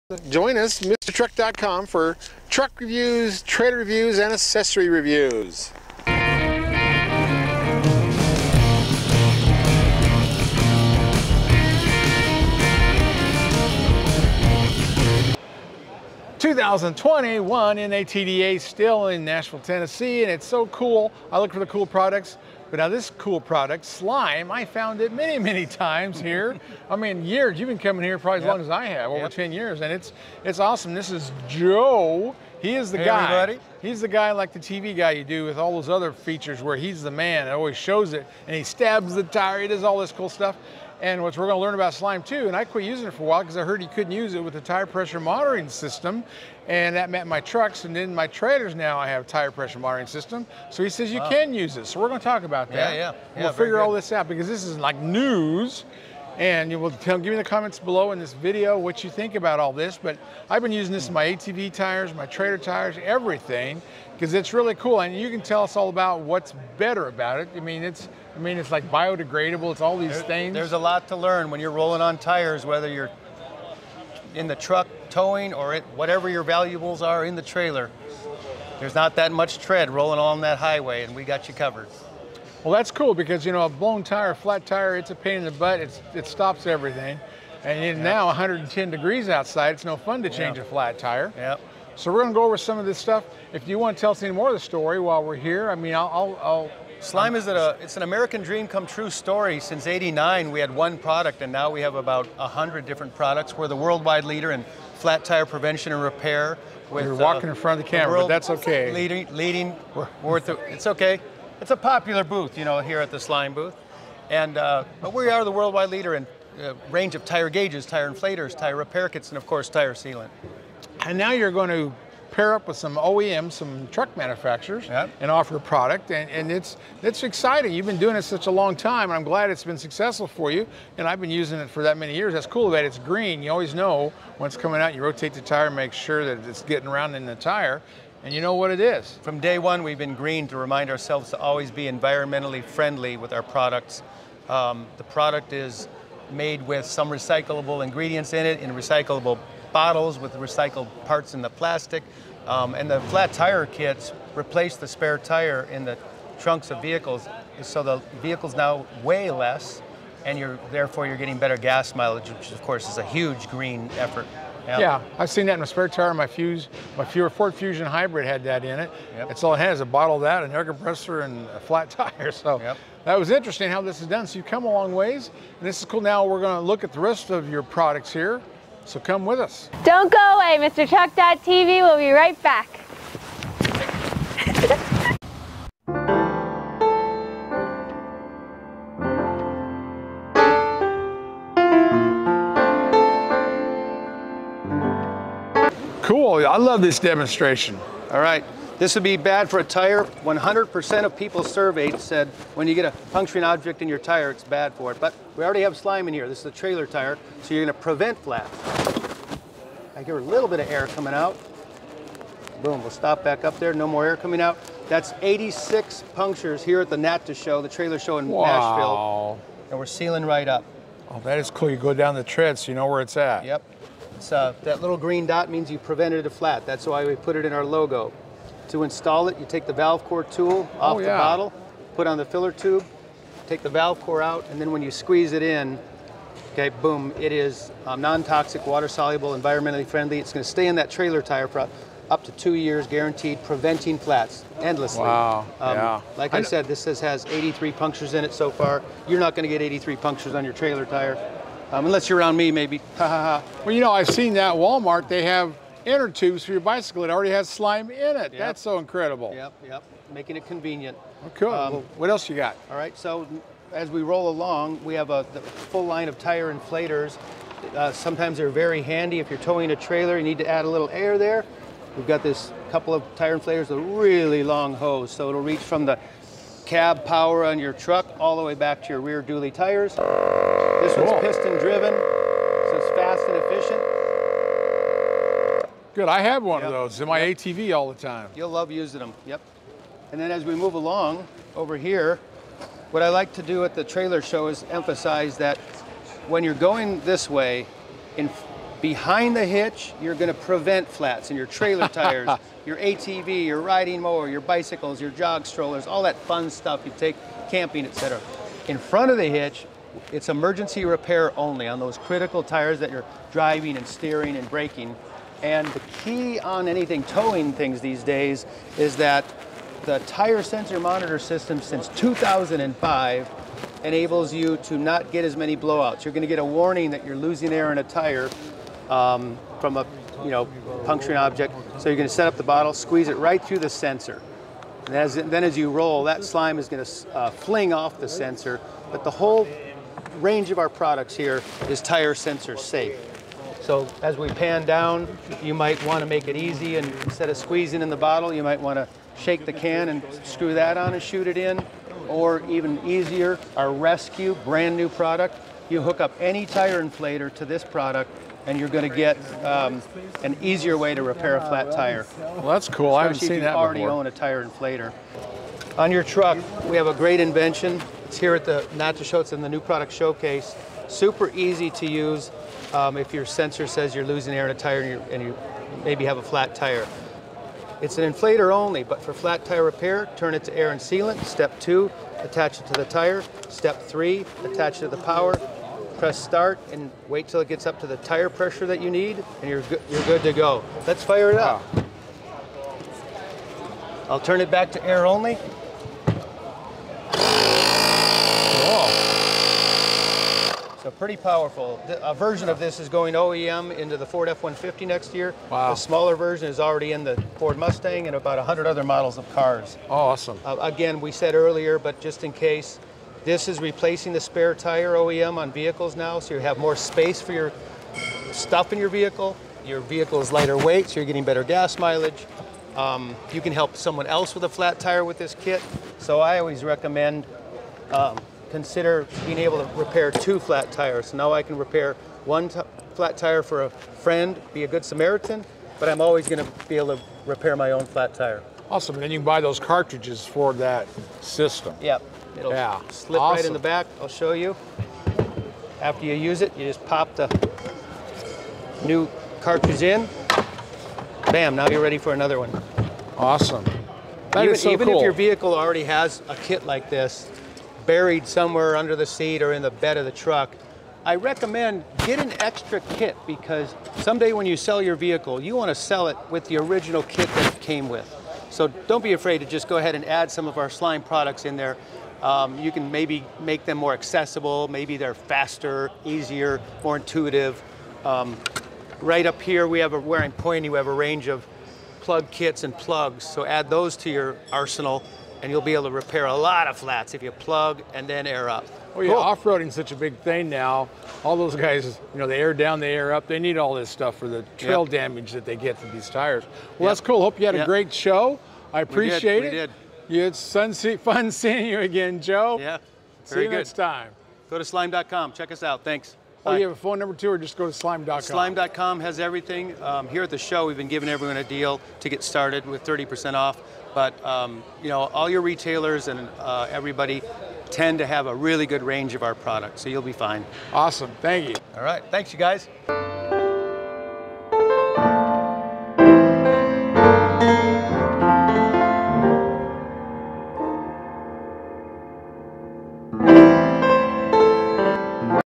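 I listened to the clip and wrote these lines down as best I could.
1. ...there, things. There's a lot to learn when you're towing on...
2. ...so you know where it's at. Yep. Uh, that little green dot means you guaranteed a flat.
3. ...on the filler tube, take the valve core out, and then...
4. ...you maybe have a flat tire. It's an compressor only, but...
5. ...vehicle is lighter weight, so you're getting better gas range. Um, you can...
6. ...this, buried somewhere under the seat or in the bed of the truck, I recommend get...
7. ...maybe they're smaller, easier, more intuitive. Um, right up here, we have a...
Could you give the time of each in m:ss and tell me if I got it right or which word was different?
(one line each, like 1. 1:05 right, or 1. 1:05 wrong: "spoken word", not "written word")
1. 1:10 wrong: "rolling", not "towing"
2. 3:42 wrong: "prevented", not "guaranteed"
3. 3:52 right
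4. 6:15 wrong: "inflator", not "compressor"
5. 6:59 wrong: "mileage", not "range"
6. 7:36 right
7. 7:54 wrong: "faster", not "smaller".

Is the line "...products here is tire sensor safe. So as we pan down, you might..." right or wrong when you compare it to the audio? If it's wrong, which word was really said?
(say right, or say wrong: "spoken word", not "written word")
right.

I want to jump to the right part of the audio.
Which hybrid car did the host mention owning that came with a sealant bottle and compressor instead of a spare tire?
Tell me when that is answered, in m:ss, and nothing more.
2:47.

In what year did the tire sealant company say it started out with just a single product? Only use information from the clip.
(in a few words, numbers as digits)
1989.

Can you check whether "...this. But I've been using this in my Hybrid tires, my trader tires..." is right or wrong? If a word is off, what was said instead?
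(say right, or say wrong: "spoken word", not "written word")
wrong: "ATV", not "Hybrid".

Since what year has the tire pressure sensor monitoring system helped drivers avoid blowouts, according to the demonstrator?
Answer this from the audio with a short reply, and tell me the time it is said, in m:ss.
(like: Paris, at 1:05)
2005, at 5:21.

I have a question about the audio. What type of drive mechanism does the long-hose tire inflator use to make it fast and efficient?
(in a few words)
Piston.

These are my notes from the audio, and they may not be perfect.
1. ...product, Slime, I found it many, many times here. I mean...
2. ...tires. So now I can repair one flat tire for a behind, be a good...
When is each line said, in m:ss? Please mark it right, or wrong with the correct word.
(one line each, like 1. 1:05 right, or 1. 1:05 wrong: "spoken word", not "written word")
1. 0:23 right
2. 7:10 wrong: "friend", not "behind".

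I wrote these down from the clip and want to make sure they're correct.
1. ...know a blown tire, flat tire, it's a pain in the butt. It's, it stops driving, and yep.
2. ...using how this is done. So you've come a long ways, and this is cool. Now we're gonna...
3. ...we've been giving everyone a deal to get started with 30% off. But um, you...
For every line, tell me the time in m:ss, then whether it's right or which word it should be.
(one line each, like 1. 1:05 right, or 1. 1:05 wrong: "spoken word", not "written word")
1. 1:23 wrong: "everything", not "driving"
2. 2:53 wrong: "interesting", not "using"
3. 8:30 right.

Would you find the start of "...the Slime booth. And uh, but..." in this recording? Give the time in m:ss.
1:53.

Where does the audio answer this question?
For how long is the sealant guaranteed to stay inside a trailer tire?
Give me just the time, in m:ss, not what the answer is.
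4:02.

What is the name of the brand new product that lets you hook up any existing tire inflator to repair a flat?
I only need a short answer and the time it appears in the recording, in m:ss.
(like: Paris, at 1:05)
Rescue, at 5:53.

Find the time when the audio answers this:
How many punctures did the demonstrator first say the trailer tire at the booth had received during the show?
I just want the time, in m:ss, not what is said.
3:35.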